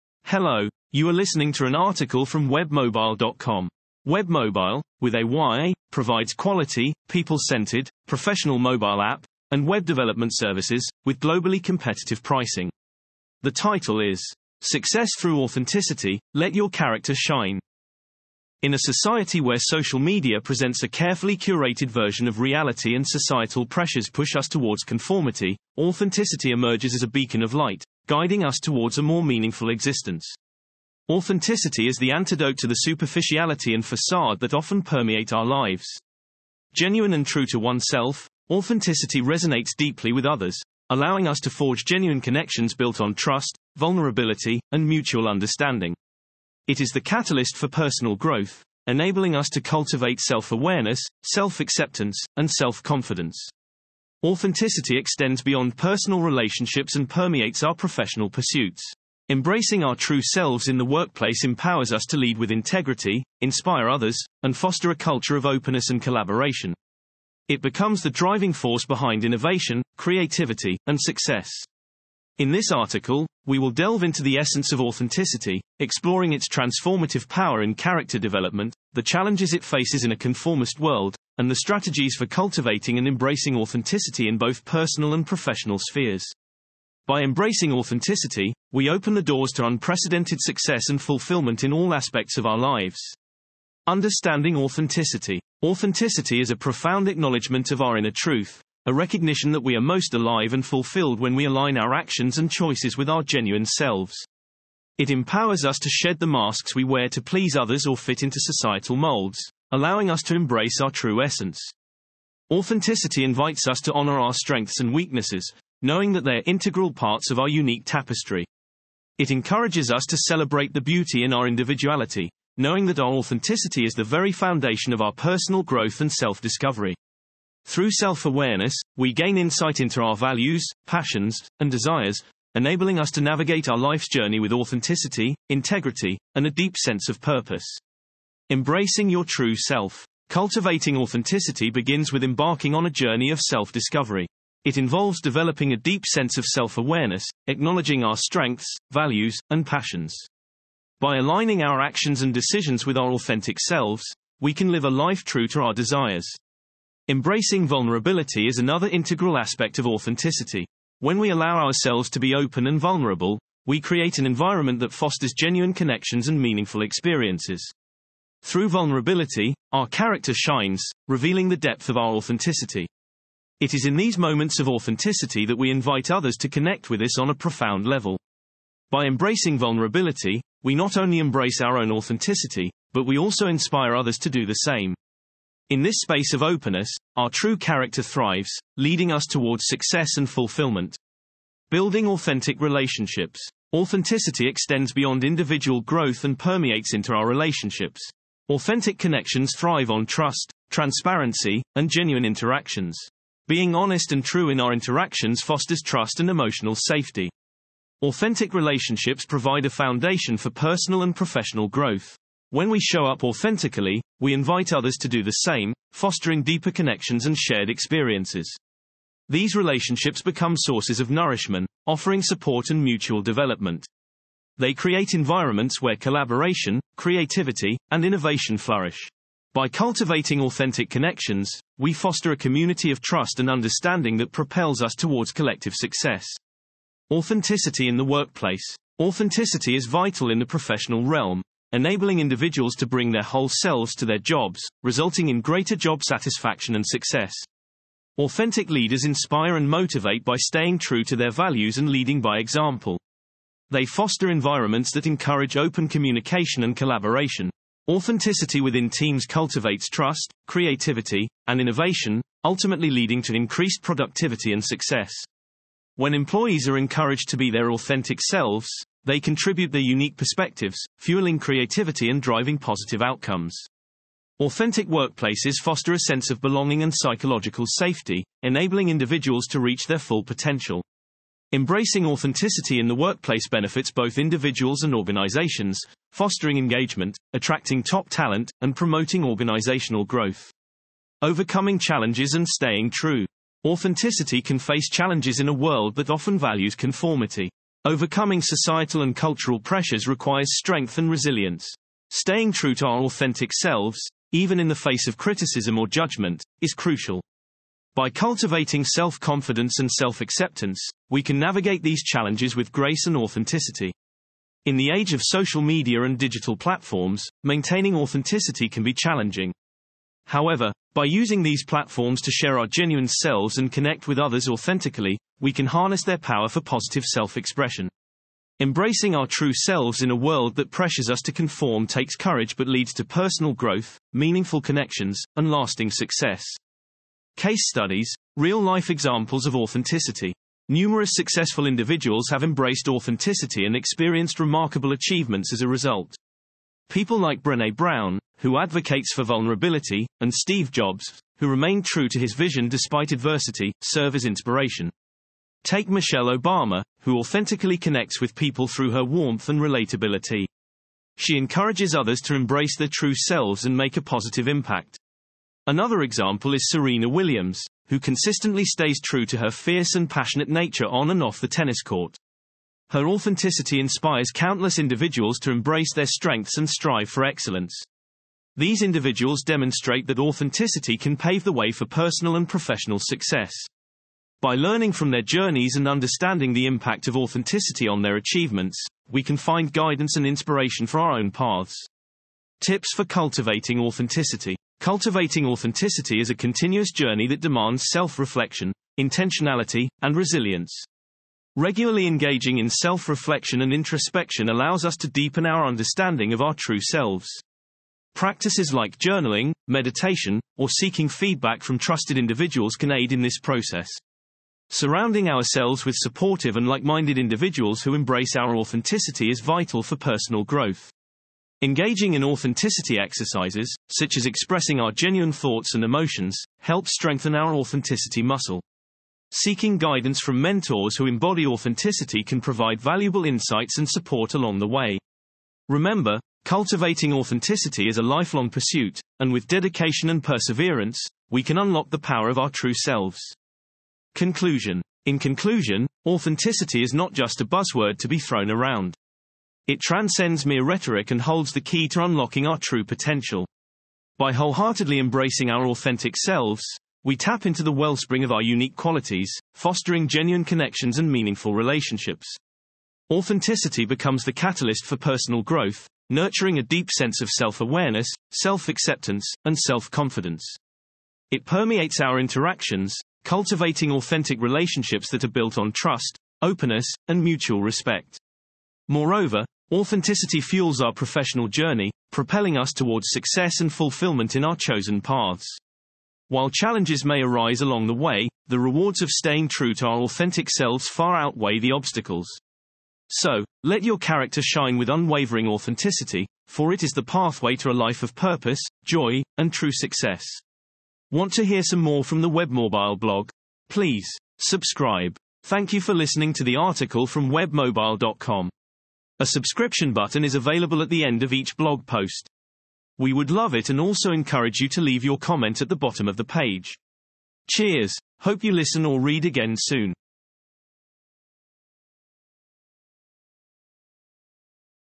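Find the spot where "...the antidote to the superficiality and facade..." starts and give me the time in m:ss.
0:31.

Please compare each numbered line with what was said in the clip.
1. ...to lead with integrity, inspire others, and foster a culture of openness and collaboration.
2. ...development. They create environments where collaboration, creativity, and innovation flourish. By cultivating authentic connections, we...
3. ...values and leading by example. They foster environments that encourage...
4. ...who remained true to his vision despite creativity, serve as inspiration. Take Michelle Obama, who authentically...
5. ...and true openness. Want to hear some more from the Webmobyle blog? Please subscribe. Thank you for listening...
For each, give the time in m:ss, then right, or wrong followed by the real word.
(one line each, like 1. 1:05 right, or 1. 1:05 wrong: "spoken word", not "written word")
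1. 1:02 right
2. 3:43 right
3. 4:11 right
4. 5:51 wrong: "adversity", not "creativity"
5. 8:19 wrong: "success", not "openness".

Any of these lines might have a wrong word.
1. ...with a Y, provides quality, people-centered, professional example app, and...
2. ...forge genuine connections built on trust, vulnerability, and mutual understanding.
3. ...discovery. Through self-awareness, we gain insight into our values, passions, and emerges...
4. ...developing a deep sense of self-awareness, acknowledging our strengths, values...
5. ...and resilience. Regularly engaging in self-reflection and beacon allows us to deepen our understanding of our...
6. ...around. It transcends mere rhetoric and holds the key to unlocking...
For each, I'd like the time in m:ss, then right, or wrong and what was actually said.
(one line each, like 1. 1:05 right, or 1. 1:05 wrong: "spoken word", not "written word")
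1. 0:05 wrong: "mobile", not "example"
2. 0:41 right
3. 2:06 wrong: "desires", not "emerges"
4. 2:25 right
5. 6:40 wrong: "introspection", not "beacon"
6. 7:28 right.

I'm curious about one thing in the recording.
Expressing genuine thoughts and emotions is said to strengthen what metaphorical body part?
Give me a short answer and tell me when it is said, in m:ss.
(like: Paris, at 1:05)
authenticity muscle, at 7:07.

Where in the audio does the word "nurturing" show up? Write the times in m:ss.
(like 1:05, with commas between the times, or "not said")
7:46.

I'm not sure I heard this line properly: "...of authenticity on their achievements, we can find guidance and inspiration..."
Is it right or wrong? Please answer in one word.
right.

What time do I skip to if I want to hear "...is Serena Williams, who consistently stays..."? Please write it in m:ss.
6:06.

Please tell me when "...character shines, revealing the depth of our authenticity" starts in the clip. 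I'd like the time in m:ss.
2:49.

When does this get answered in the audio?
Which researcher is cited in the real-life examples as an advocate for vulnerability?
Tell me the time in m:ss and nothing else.
5:47.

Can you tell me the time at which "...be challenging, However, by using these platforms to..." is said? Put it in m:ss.
5:18.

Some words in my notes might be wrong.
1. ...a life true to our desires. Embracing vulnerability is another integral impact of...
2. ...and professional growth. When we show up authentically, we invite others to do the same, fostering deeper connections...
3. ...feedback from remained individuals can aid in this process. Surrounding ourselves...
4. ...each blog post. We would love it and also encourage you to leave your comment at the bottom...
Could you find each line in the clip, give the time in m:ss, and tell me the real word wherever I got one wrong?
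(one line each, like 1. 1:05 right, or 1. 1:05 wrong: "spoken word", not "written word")
1. 2:34 wrong: "aspect", not "impact"
2. 3:31 right
3. 6:51 wrong: "trusted", not "remained"
4. 8:31 right.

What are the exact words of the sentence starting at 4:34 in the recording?
Authentic workplaces foster a sense of belonging and psychological safety, enabling individuals to reach their full potential.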